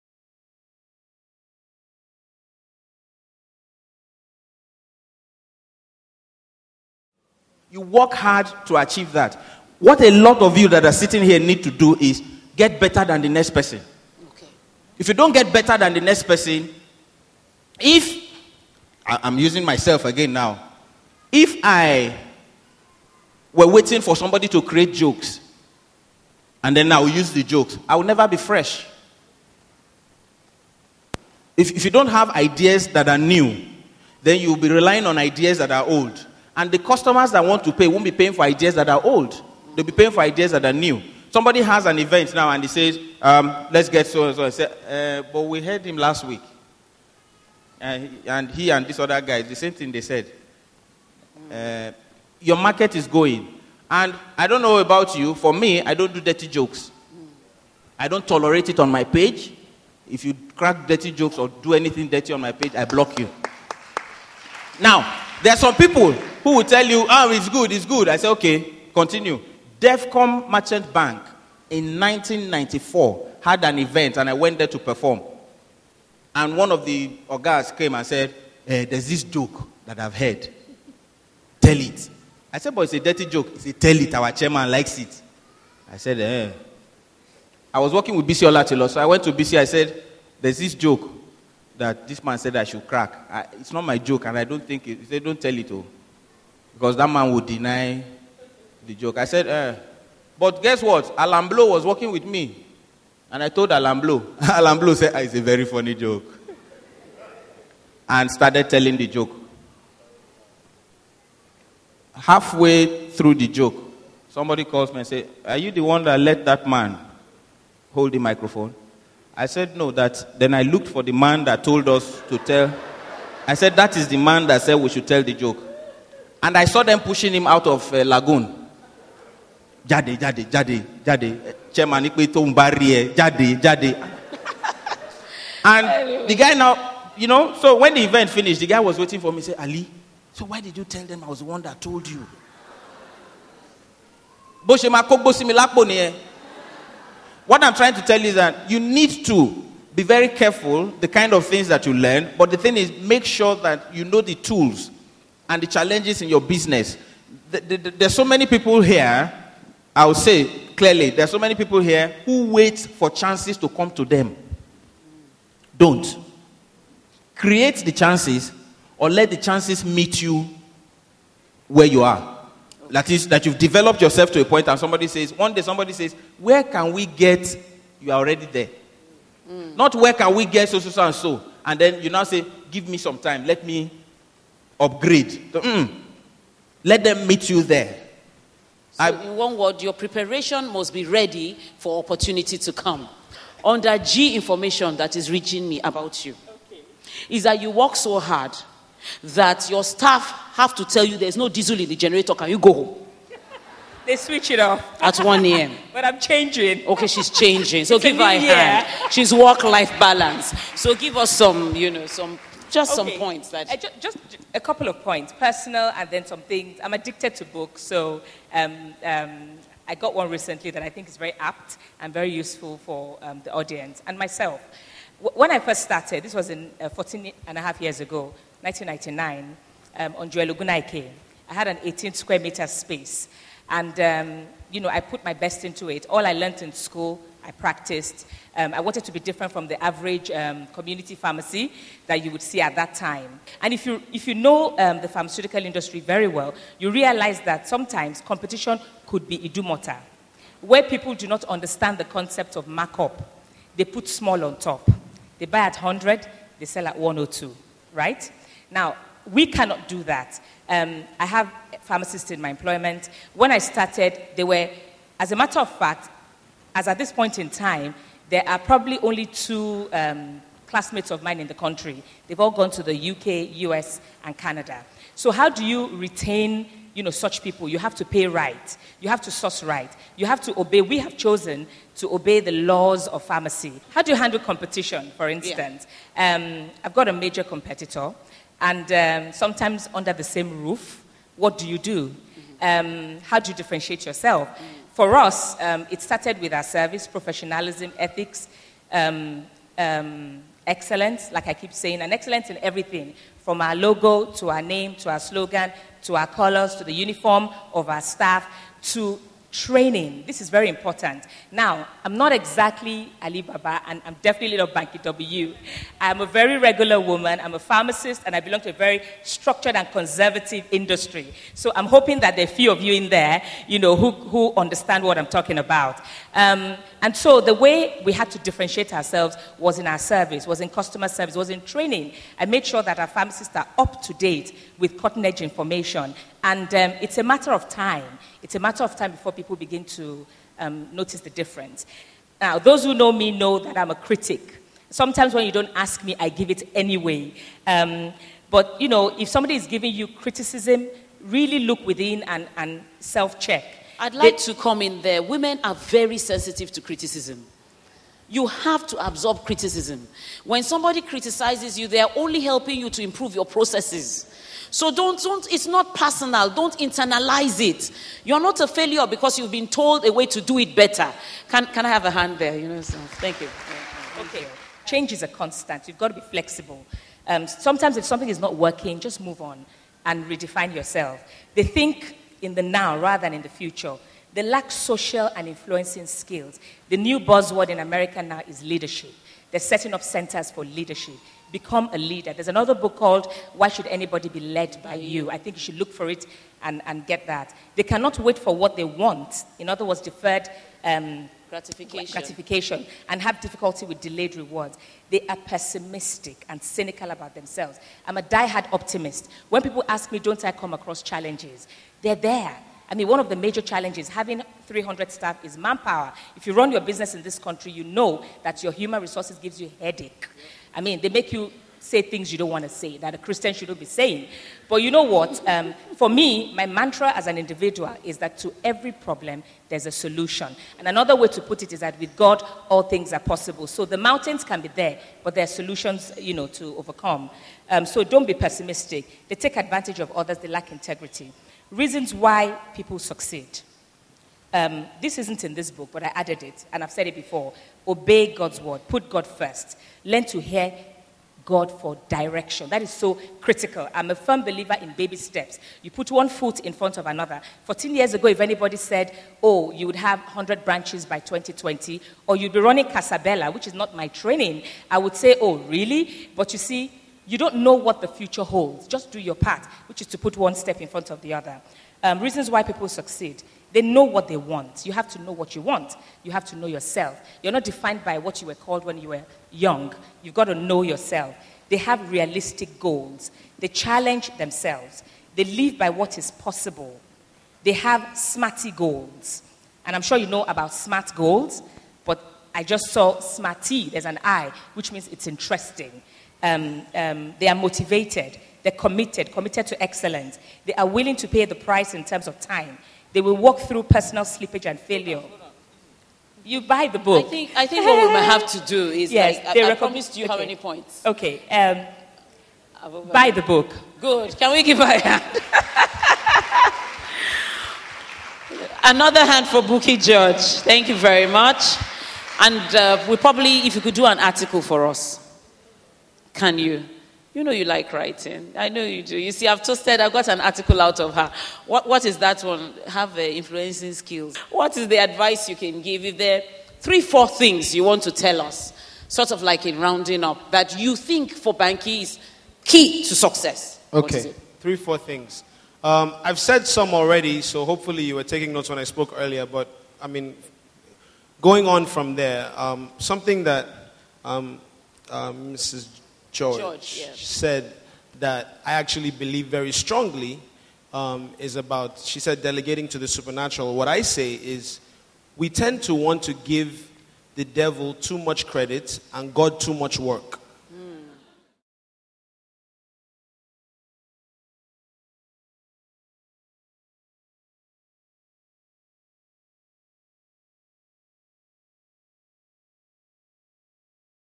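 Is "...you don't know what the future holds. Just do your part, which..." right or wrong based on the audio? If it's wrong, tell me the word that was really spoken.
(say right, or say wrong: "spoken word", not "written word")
right.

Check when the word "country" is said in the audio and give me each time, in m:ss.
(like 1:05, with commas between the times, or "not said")
4:31, 6:57.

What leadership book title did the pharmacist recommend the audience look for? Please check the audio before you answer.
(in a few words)
Why Should Anybody Be Led by You?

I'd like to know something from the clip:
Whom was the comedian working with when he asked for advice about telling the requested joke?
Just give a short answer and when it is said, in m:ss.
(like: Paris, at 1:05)
Bisi Olatilo, at 1:28.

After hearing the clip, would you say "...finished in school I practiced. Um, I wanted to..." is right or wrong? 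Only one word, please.
wrong.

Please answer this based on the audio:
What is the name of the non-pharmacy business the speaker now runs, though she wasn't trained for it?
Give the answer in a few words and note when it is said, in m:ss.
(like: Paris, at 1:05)
Casabella, at 7:42.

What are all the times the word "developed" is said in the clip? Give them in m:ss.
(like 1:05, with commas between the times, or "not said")
2:53.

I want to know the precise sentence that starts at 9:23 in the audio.
What I say is we tend to want to give the devil too much credit and God too much work.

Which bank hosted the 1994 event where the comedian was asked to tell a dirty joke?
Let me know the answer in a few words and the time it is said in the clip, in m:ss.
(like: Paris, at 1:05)
Devcom Merchant Bank, at 1:09.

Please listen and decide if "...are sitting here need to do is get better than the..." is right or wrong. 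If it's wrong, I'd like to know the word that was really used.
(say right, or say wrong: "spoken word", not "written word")
right.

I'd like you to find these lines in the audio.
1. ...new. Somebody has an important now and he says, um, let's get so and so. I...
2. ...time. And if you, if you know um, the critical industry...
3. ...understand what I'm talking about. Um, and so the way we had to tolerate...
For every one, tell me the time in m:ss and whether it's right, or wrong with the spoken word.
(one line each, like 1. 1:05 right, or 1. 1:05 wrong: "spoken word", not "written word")
1. 0:40 wrong: "event", not "important"
2. 4:02 wrong: "pharmaceutical", not "critical"
3. 5:24 wrong: "differentiate", not "tolerate".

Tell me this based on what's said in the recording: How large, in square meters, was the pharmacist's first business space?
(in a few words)
18.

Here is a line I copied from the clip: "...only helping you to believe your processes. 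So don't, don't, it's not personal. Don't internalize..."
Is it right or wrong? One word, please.
wrong.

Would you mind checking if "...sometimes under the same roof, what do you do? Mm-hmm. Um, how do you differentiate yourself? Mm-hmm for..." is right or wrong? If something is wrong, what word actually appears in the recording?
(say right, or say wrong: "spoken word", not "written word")
right.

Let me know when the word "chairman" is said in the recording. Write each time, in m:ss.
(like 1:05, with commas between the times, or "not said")
1:24, 2:11.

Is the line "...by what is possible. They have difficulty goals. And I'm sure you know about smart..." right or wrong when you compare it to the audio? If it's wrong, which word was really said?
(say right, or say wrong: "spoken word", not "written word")
wrong: "smarty", not "difficulty".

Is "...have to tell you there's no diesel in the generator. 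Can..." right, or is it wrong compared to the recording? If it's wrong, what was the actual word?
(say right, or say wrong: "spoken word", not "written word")
right.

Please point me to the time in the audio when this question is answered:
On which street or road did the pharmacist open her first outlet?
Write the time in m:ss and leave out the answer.
3:50.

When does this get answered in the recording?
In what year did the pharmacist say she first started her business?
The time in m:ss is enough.
3:48.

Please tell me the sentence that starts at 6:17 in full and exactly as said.
Um, sometimes if something is not working, just move on and redefine yourself.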